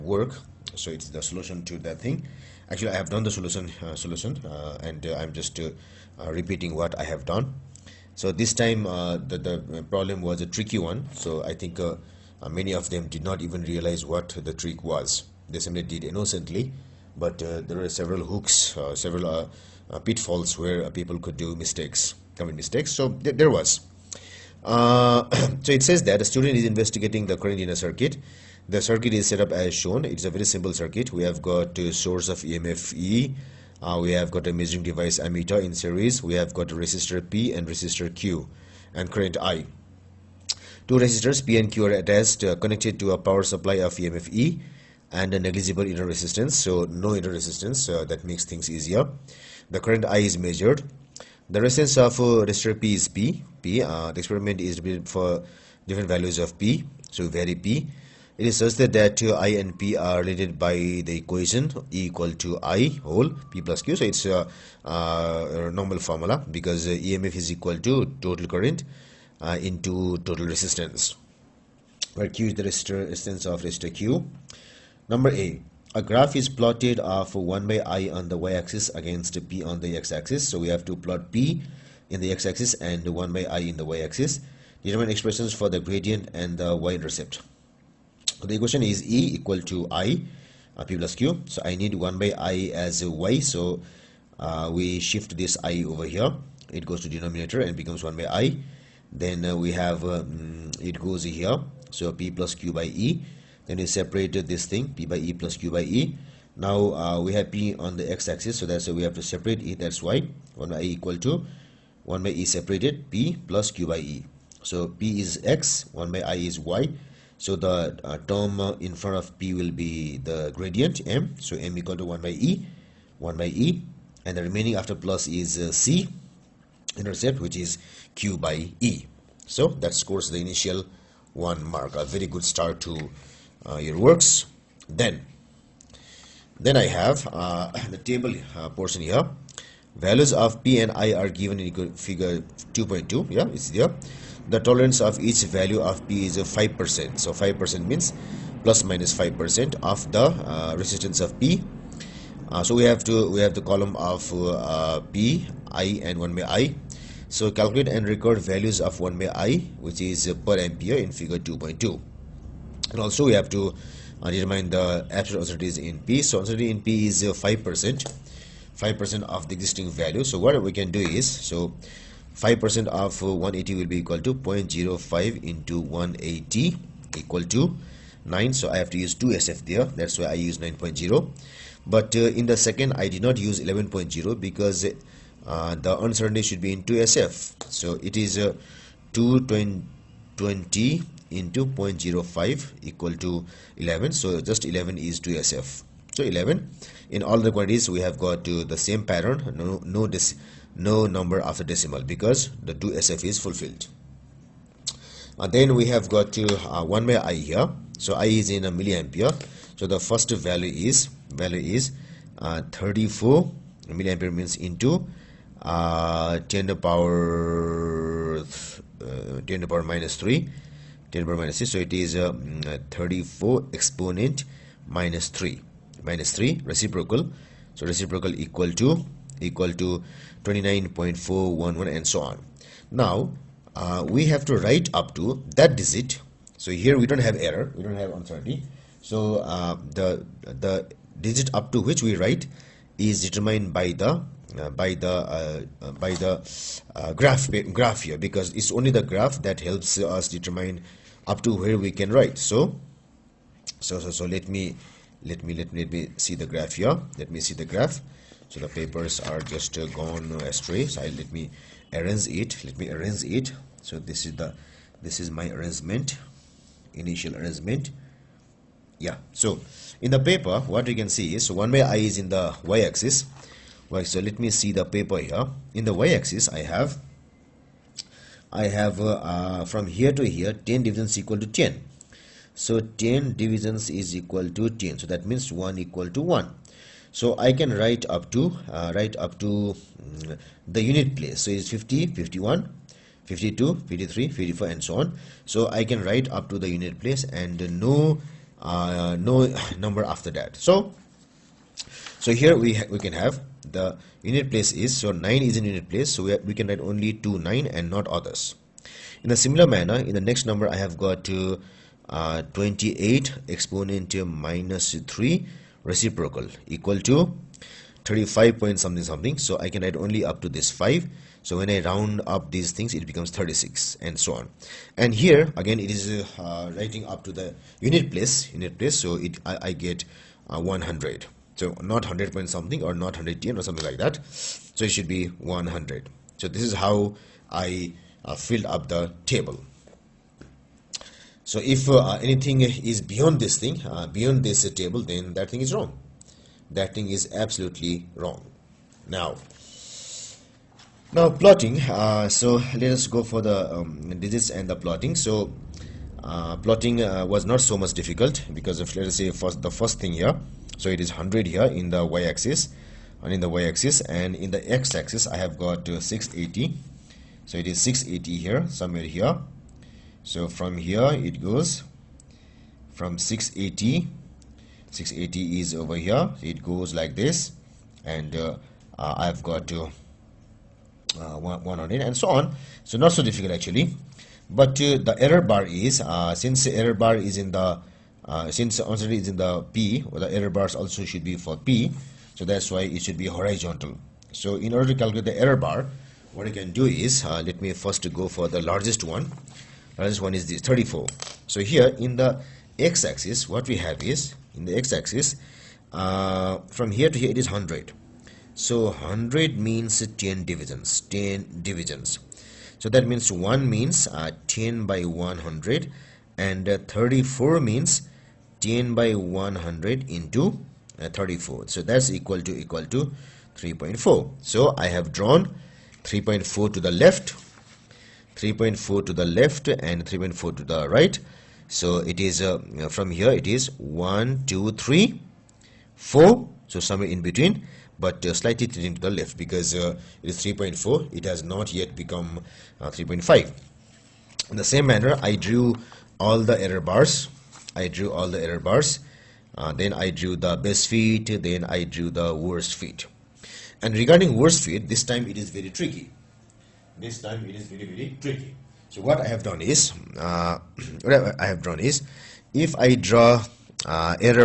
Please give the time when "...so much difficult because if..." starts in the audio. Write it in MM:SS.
05:57.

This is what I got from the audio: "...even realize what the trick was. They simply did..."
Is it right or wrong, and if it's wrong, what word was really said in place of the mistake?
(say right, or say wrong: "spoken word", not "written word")
right.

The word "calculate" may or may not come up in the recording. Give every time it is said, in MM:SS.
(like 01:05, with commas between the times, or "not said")
02:37, 06:34.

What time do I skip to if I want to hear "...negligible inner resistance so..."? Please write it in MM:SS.
00:45.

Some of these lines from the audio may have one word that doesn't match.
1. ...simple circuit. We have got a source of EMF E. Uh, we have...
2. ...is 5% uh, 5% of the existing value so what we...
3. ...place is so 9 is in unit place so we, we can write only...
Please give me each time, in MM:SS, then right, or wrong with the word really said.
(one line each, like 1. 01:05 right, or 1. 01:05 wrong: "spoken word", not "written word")
1. 00:30 right
2. 02:47 right
3. 05:04 right.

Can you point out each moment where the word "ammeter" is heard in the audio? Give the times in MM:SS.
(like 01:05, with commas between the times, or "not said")
00:35.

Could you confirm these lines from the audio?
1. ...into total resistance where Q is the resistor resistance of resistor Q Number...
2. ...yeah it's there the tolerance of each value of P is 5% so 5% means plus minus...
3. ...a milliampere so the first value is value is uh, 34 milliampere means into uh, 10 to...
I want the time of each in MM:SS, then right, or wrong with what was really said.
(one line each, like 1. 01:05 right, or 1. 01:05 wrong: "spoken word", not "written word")
1. 01:09 right
2. 02:23 right
3. 03:28 right.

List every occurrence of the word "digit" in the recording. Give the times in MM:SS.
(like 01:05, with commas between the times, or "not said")
03:55, 04:01, 05:54.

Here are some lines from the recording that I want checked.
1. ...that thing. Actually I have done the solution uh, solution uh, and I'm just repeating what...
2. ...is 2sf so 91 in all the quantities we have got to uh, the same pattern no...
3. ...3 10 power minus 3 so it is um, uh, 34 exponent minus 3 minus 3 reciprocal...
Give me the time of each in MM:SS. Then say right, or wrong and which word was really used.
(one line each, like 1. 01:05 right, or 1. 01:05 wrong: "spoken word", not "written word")
1. 00:01 right
2. 03:14 wrong: "11", not "91"
3. 03:40 wrong: "6", not "3".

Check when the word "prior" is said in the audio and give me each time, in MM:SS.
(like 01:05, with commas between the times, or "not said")
not said.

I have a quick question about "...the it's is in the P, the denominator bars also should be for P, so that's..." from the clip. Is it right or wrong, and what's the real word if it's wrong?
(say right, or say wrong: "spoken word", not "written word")
wrong: "error", not "denominator".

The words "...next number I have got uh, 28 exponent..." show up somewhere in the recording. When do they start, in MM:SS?
05:10.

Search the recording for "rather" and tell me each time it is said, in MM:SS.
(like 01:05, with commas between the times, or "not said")
not said.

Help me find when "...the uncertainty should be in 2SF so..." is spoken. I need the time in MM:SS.
03:05.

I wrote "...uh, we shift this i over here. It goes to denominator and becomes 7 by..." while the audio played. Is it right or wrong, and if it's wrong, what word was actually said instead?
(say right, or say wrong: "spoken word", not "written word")
wrong: "1", not "7".